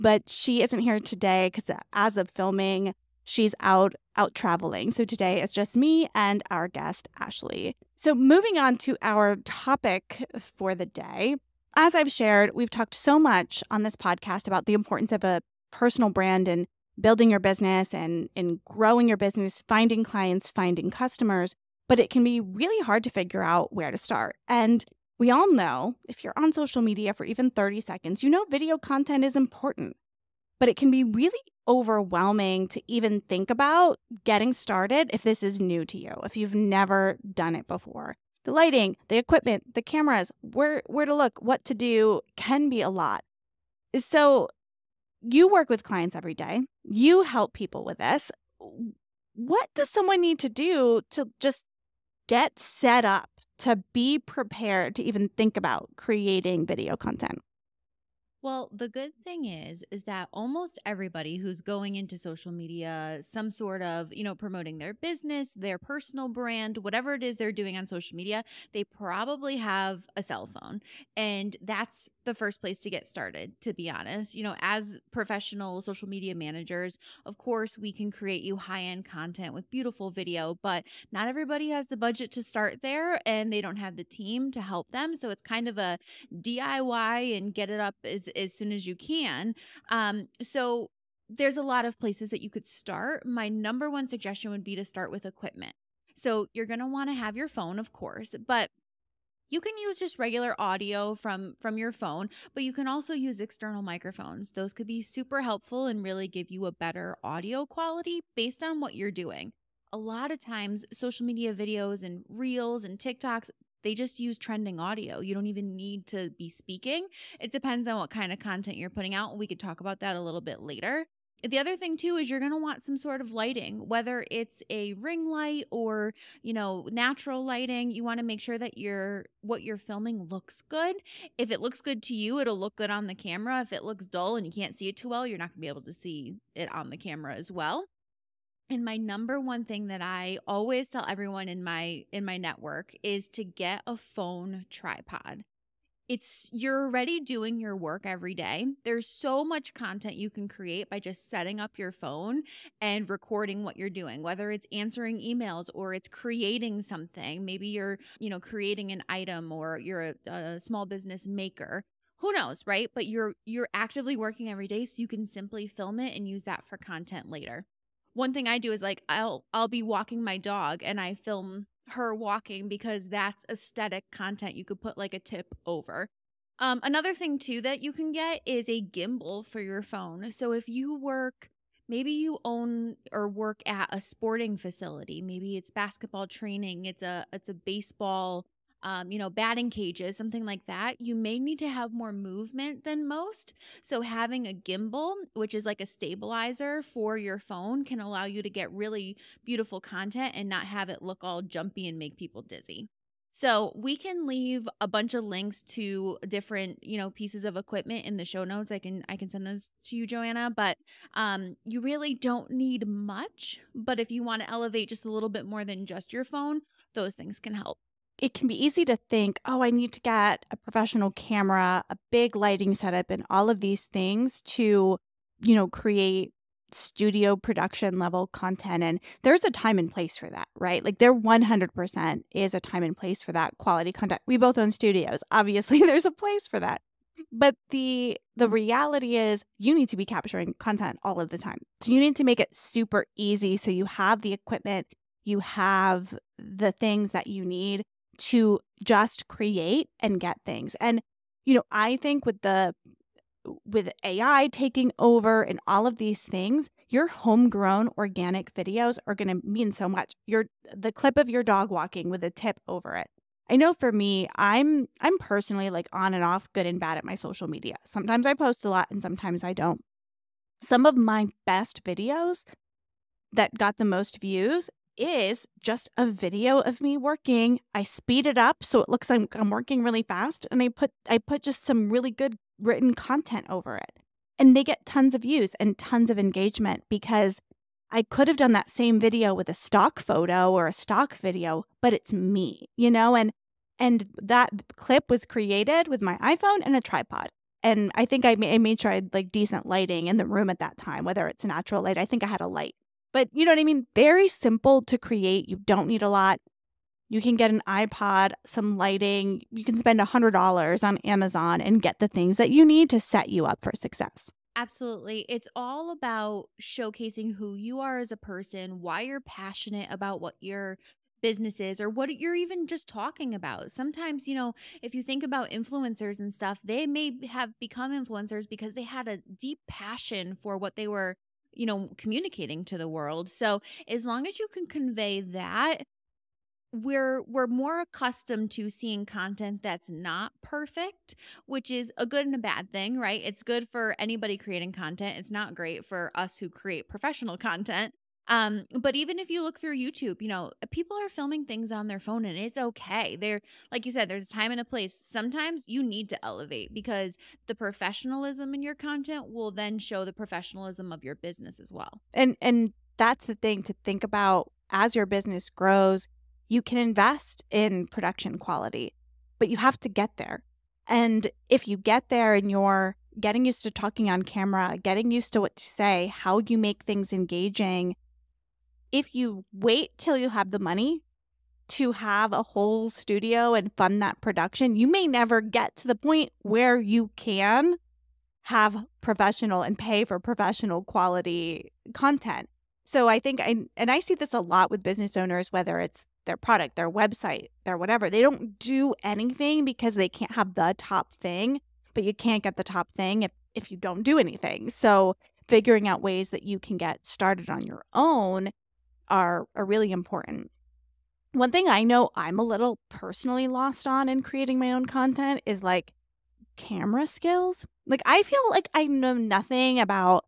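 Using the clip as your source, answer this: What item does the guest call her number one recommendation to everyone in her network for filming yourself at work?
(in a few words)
phone tripod.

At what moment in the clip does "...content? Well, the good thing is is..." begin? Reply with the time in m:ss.
0:56.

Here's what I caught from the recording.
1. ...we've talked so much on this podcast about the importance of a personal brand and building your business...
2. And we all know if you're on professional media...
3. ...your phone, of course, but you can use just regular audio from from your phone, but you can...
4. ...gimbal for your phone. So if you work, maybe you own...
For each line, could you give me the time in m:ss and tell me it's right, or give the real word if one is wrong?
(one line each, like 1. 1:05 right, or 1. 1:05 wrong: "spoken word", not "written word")
1. 0:12 right
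2. 0:24 wrong: "social", not "professional"
3. 1:37 right
4. 2:58 right.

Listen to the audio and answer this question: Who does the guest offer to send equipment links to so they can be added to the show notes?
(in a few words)
Joanna.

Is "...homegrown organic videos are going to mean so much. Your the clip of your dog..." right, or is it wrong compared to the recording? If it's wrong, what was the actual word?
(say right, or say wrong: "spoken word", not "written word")
right.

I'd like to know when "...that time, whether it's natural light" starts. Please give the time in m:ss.
5:00.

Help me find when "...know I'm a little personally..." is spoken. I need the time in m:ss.
6:51.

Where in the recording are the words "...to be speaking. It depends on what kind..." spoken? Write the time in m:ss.
1:56.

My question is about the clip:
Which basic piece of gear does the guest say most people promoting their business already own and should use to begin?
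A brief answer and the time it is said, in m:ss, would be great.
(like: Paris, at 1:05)
cell phone, at 1:10.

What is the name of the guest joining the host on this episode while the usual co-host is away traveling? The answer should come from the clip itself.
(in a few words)
Ashley.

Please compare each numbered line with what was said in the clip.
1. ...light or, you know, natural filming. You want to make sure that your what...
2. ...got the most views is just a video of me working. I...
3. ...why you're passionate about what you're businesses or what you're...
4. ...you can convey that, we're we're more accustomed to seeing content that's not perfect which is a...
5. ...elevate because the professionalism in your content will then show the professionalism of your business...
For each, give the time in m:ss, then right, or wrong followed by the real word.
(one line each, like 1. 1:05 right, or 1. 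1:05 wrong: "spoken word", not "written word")
1. 2:05 wrong: "lighting", not "filming"
2. 4:33 right
3. 5:18 right
4. 5:34 right
5. 5:56 right.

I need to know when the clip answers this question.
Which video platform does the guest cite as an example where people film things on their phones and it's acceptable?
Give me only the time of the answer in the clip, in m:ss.
5:49.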